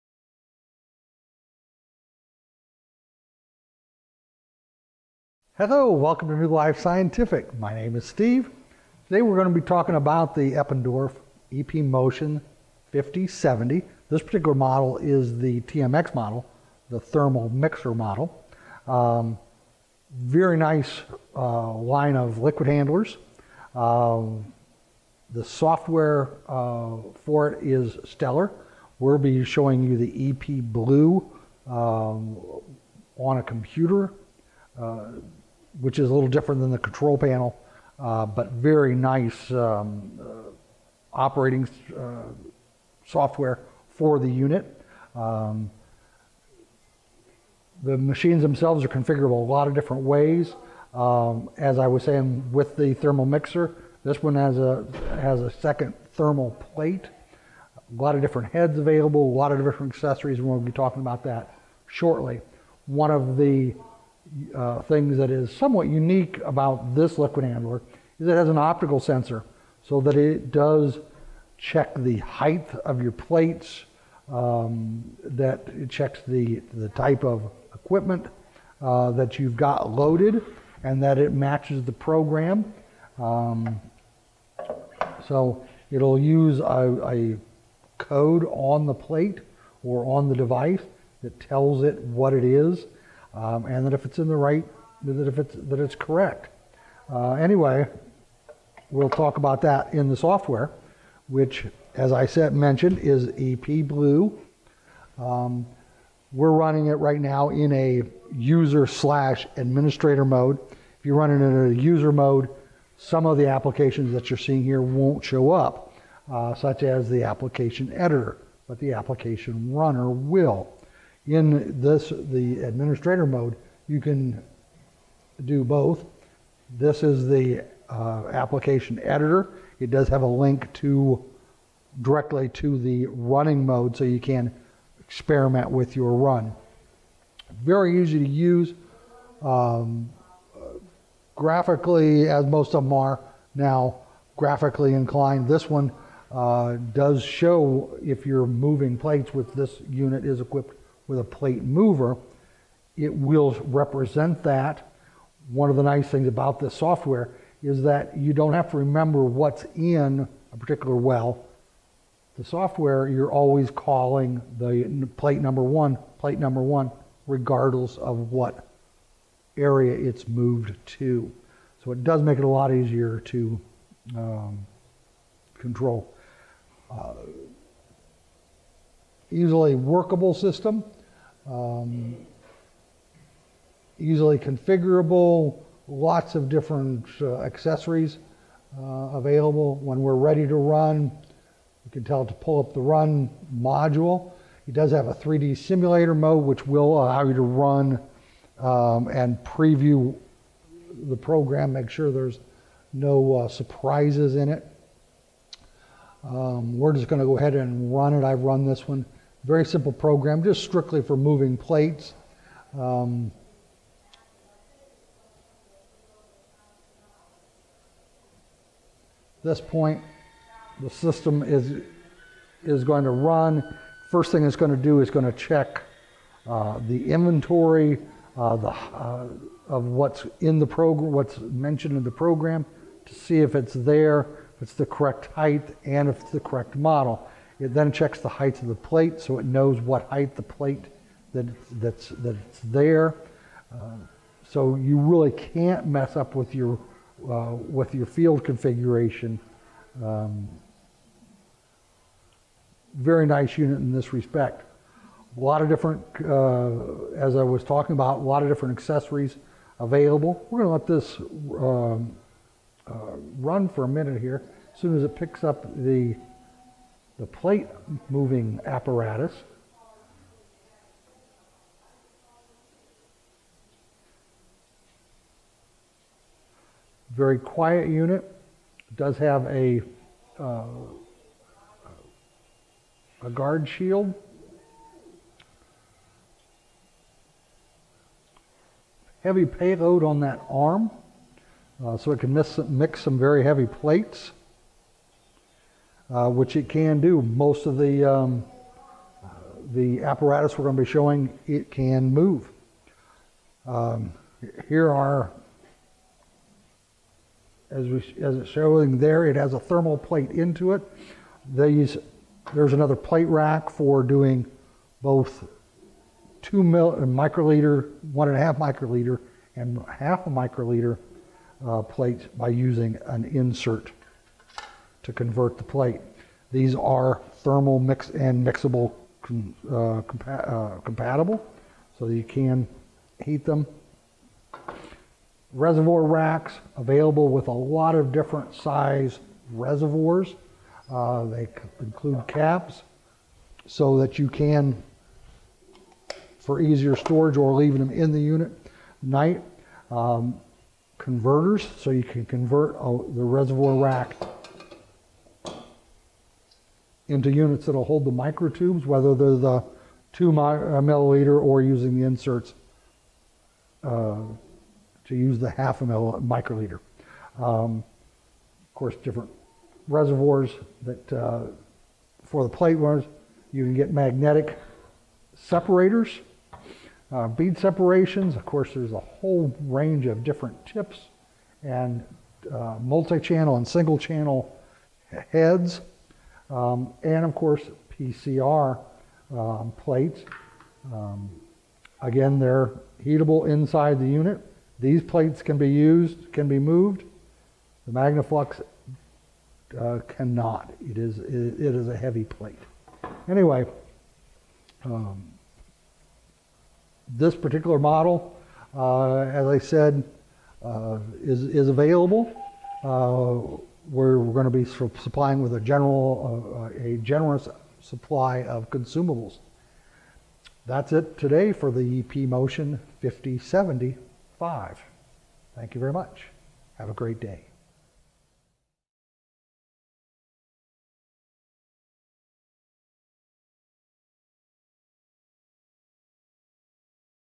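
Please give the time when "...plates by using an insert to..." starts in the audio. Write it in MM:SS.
05:21.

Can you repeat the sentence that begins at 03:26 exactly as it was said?
Um, we're just going to go ahead and run it.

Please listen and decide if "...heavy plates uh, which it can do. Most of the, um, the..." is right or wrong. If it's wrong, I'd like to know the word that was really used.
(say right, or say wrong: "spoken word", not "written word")
right.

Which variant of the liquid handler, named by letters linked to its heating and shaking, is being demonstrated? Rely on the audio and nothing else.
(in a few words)
TMX.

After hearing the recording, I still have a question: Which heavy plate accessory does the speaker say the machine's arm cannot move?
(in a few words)
Magnaflux.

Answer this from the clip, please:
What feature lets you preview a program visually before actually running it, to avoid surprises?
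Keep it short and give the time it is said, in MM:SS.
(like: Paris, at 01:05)
3D simulator mode, at 03:15.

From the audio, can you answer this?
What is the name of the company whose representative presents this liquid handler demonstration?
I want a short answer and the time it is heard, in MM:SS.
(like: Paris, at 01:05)
New Life Scientific, at 00:06.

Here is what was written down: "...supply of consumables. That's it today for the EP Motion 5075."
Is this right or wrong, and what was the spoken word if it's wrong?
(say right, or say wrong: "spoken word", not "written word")
right.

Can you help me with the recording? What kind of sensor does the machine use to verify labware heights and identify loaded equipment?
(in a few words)
Optical sensor.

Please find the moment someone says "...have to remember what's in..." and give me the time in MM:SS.
02:38.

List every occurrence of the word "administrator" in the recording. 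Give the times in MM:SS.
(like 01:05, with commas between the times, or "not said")
01:49, 02:02.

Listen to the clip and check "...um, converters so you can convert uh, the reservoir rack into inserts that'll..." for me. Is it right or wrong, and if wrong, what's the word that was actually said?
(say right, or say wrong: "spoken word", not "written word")
wrong: "units", not "inserts".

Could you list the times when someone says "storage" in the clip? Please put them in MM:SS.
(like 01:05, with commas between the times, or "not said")
05:46.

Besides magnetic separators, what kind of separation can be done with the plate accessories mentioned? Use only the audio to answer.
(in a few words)
Bead separations.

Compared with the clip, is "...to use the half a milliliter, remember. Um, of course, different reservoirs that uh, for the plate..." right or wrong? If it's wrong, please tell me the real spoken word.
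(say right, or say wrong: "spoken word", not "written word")
wrong: "microliter", not "remember".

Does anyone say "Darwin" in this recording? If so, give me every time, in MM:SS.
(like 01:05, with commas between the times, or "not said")
not said.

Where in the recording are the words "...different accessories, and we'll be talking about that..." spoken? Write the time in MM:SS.
00:59.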